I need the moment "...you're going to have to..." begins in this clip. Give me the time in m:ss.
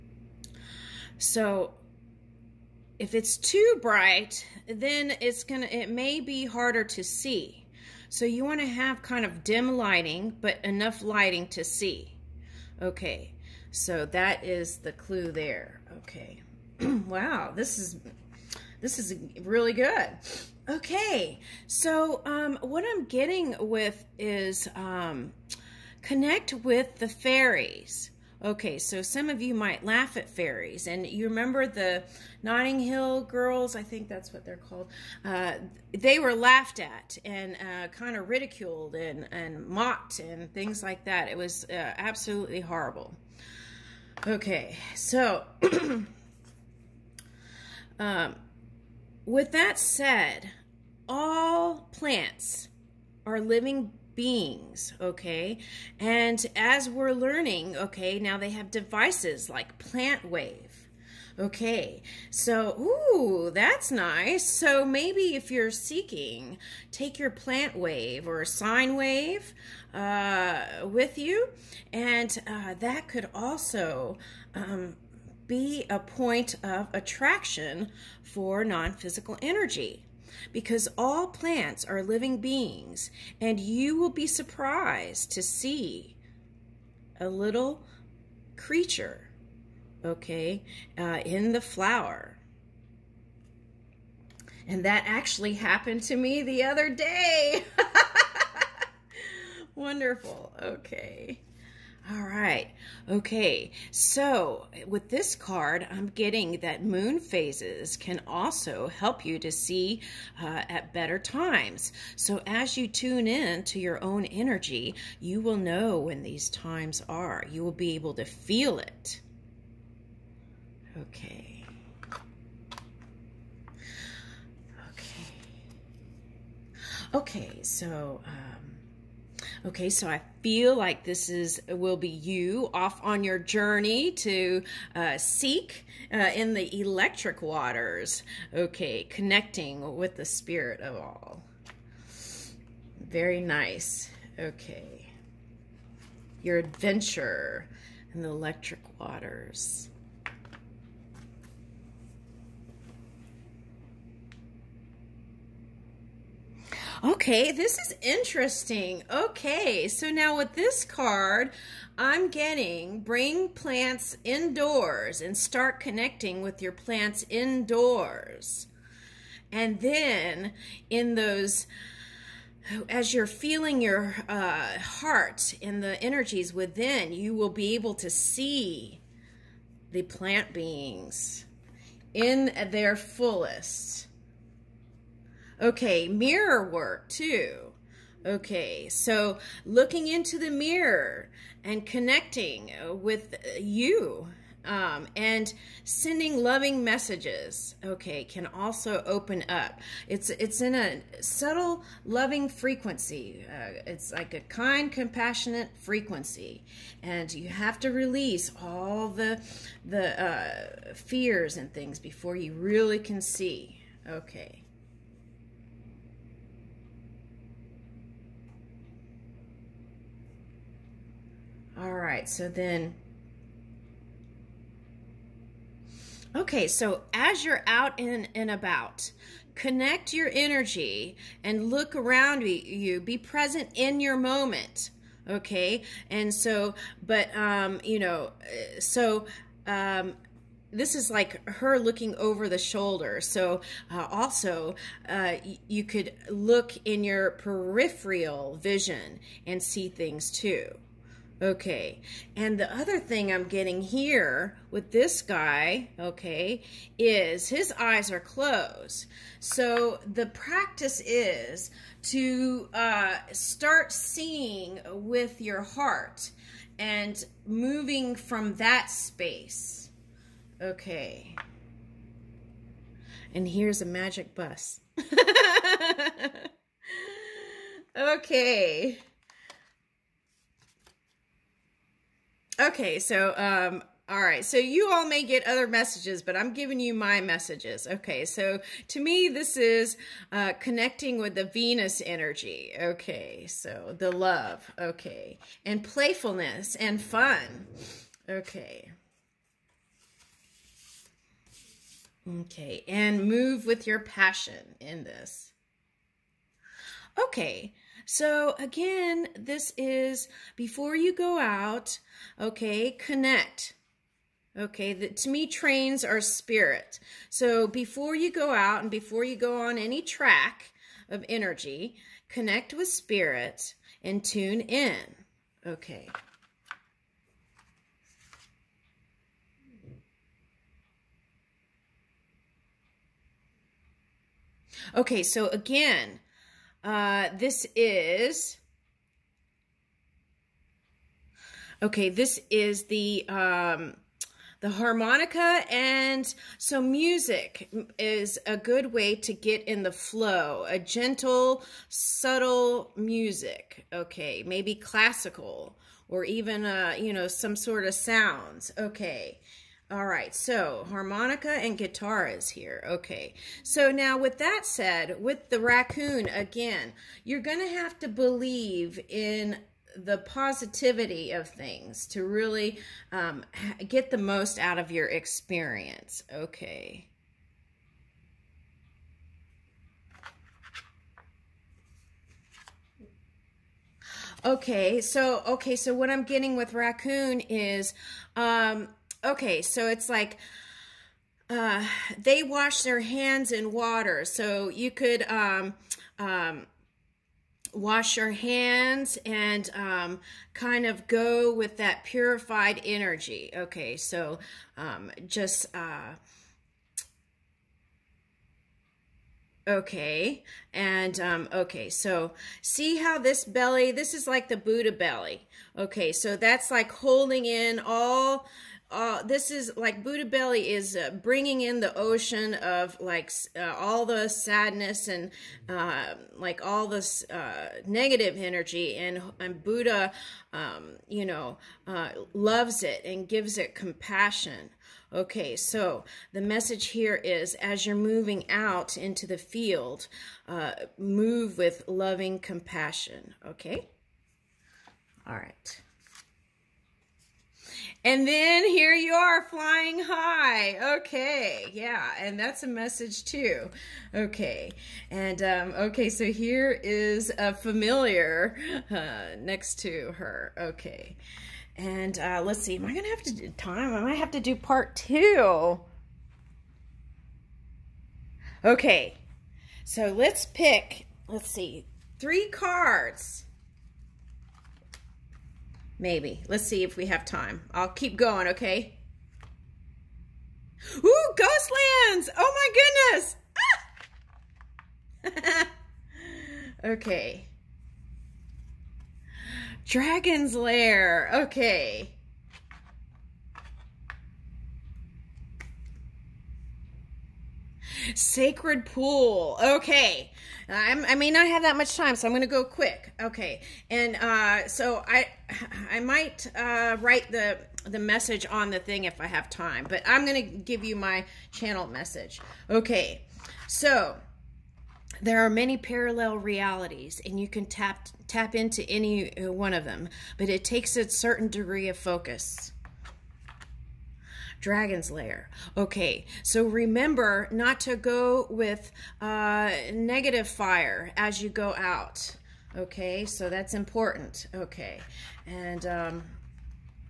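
6:07.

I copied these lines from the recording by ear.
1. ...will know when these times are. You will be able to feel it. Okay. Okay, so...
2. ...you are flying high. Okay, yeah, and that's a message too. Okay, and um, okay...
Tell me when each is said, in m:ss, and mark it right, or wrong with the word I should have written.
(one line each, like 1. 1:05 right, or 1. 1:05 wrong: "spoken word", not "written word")
1. 1:55 right
2. 7:28 right.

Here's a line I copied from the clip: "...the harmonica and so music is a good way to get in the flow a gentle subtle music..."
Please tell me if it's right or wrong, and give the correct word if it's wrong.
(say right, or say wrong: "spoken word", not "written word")
right.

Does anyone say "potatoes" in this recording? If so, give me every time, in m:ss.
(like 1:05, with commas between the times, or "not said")
not said.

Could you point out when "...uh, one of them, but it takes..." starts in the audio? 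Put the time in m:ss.
8:39.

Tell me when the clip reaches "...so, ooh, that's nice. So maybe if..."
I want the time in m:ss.
1:02.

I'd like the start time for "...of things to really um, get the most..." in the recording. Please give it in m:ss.
6:11.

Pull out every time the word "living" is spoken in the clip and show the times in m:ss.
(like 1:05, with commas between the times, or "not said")
0:53, 1:22.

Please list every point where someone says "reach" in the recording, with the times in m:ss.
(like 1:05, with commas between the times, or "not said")
not said.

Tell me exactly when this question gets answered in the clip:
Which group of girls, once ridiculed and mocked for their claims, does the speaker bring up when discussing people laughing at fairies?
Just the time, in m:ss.
0:32.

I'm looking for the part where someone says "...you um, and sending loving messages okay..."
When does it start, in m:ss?
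3:13.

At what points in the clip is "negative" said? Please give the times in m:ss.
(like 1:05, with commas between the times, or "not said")
7:07, 8:49.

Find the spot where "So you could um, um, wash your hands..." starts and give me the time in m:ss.
6:34.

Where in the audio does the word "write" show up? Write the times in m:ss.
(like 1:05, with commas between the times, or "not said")
8:26.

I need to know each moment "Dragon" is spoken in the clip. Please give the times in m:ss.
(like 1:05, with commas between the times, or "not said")
8:09, 8:44.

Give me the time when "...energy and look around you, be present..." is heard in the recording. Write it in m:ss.
3:50.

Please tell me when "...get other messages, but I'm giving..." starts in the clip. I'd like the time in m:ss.
4:45.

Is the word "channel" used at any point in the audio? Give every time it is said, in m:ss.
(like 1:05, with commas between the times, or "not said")
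8:31.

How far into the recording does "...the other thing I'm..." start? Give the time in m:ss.
4:12.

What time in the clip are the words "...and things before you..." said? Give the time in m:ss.
3:31.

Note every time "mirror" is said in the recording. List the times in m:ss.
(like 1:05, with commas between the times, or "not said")
3:06, 3:10.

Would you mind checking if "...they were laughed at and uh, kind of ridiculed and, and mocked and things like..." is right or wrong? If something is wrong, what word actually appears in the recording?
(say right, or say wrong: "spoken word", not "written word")
right.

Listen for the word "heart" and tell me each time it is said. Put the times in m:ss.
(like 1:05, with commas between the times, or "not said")
2:54, 4:25.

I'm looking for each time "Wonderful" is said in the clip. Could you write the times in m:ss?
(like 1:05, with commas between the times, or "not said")
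1:39.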